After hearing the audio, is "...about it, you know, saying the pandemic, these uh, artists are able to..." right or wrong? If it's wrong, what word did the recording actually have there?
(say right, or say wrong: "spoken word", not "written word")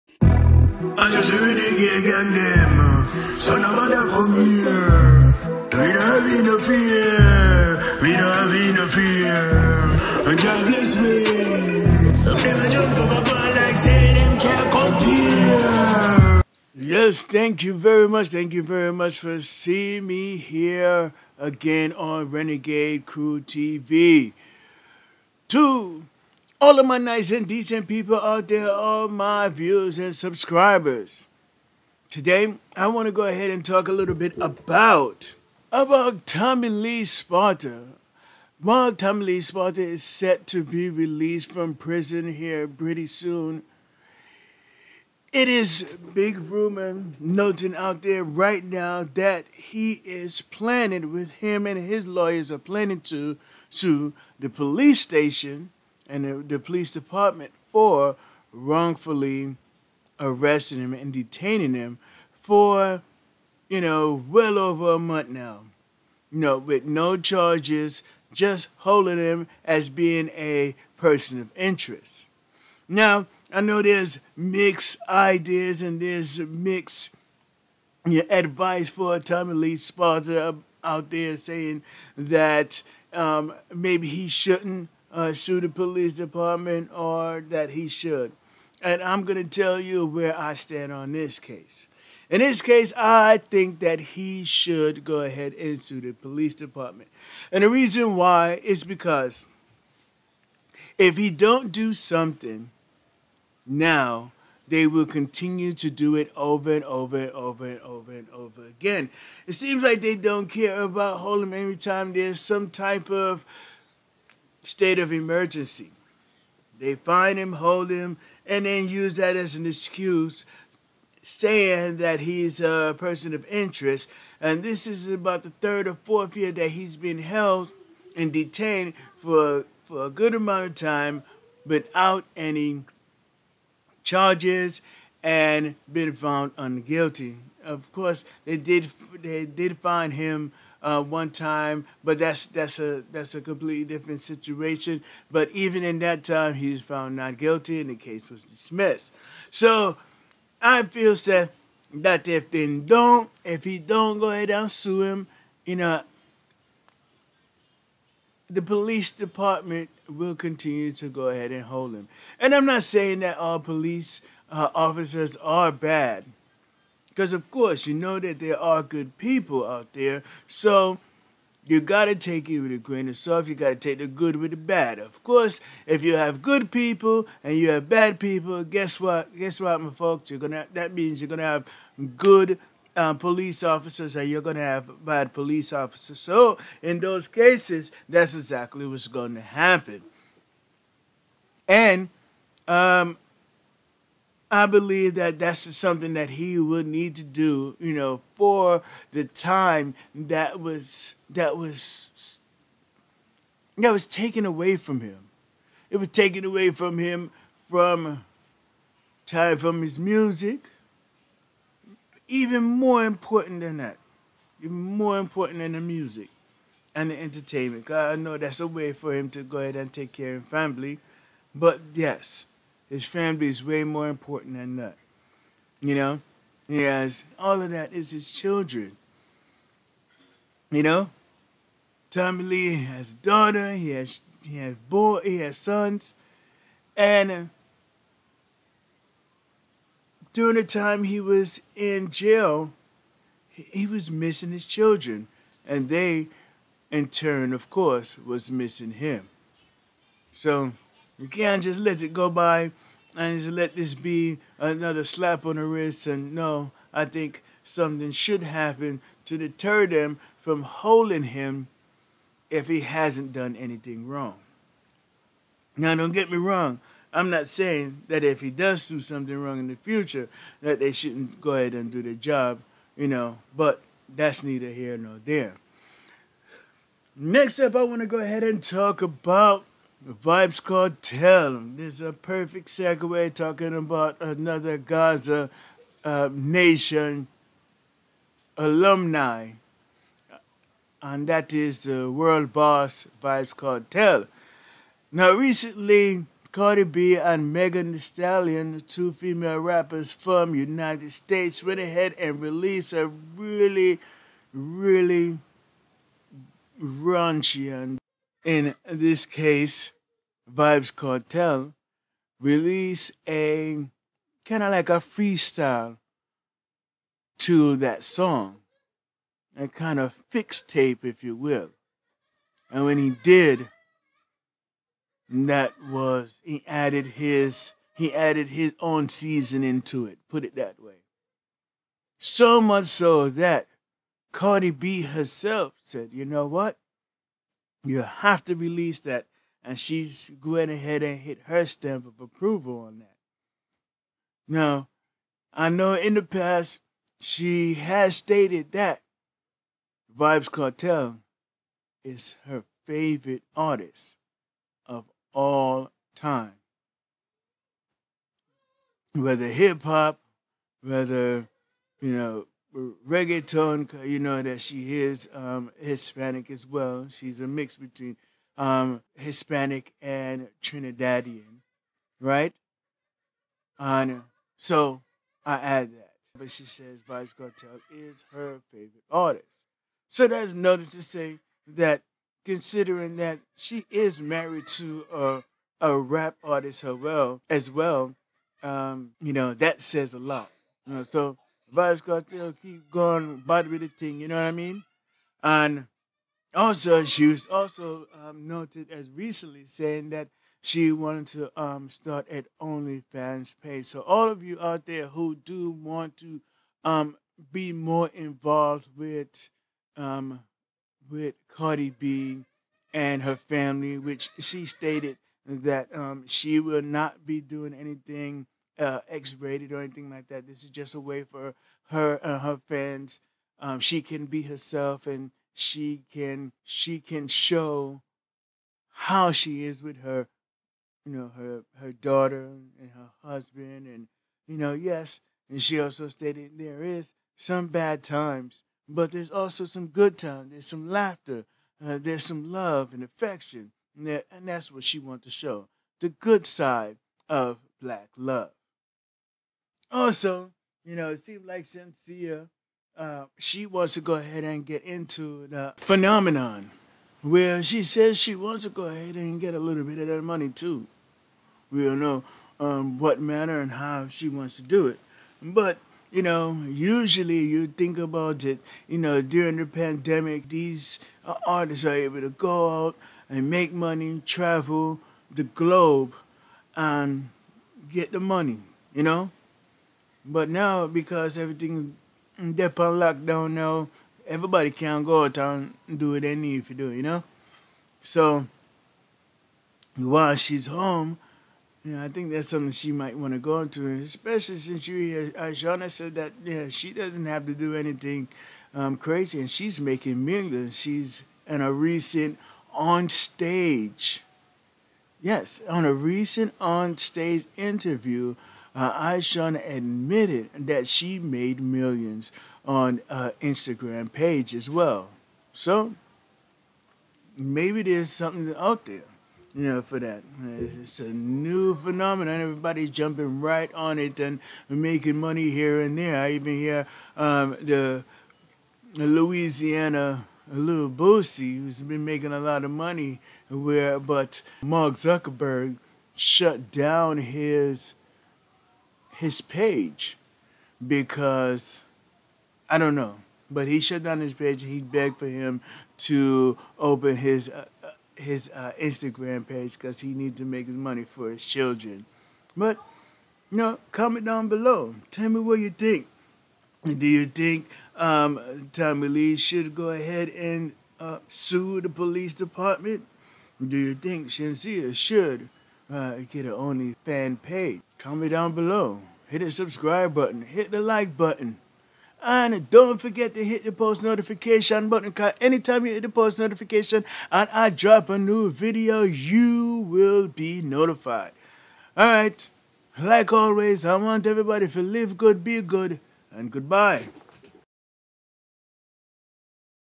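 wrong: "during", not "saying".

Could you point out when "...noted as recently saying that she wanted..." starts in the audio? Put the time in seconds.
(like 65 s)
398 s.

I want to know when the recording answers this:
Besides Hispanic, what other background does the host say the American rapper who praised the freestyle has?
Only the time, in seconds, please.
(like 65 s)
370 s.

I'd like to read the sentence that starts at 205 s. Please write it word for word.
It was taken away from him from time from his music.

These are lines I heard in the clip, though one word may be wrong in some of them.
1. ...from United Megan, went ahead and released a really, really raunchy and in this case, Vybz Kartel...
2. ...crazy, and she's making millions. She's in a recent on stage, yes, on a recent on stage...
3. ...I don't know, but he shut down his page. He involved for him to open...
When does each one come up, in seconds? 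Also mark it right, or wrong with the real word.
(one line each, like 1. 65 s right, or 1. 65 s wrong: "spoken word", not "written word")
1. 300 s wrong: "States", not "Megan"
2. 498 s right
3. 542 s wrong: "begged", not "involved".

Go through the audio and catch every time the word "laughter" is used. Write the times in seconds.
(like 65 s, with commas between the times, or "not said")
440 s.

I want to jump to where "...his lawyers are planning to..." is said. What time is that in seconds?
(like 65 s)
51 s.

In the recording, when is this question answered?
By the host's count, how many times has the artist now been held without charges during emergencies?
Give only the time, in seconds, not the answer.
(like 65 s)
125 s.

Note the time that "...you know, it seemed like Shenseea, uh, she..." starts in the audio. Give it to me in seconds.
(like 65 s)
450 s.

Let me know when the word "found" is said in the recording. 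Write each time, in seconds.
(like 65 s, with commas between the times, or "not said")
136 s, 146 s.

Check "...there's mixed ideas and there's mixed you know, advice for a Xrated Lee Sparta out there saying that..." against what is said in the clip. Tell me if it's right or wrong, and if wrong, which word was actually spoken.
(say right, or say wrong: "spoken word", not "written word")
wrong: "Tommy", not "Xrated".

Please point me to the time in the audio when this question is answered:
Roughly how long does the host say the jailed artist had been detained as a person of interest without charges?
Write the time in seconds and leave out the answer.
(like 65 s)
64 s.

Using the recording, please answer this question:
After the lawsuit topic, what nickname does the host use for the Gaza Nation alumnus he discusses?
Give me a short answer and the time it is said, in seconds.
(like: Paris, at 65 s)
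world boss, at 292 s.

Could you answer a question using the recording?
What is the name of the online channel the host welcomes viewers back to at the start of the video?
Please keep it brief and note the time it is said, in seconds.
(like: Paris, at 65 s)
Renegade Krew TV, at 22 s.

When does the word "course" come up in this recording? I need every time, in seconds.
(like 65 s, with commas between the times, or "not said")
137 s, 167 s, 175 s, 247 s.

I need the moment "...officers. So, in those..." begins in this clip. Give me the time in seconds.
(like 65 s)
185 s.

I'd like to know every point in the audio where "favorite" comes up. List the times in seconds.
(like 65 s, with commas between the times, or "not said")
352 s, 378 s.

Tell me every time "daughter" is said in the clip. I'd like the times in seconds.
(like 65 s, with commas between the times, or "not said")
233 s, 431 s.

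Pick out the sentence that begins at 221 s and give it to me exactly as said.
But yes, his family is way more important than that.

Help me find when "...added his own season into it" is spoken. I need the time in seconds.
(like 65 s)
328 s.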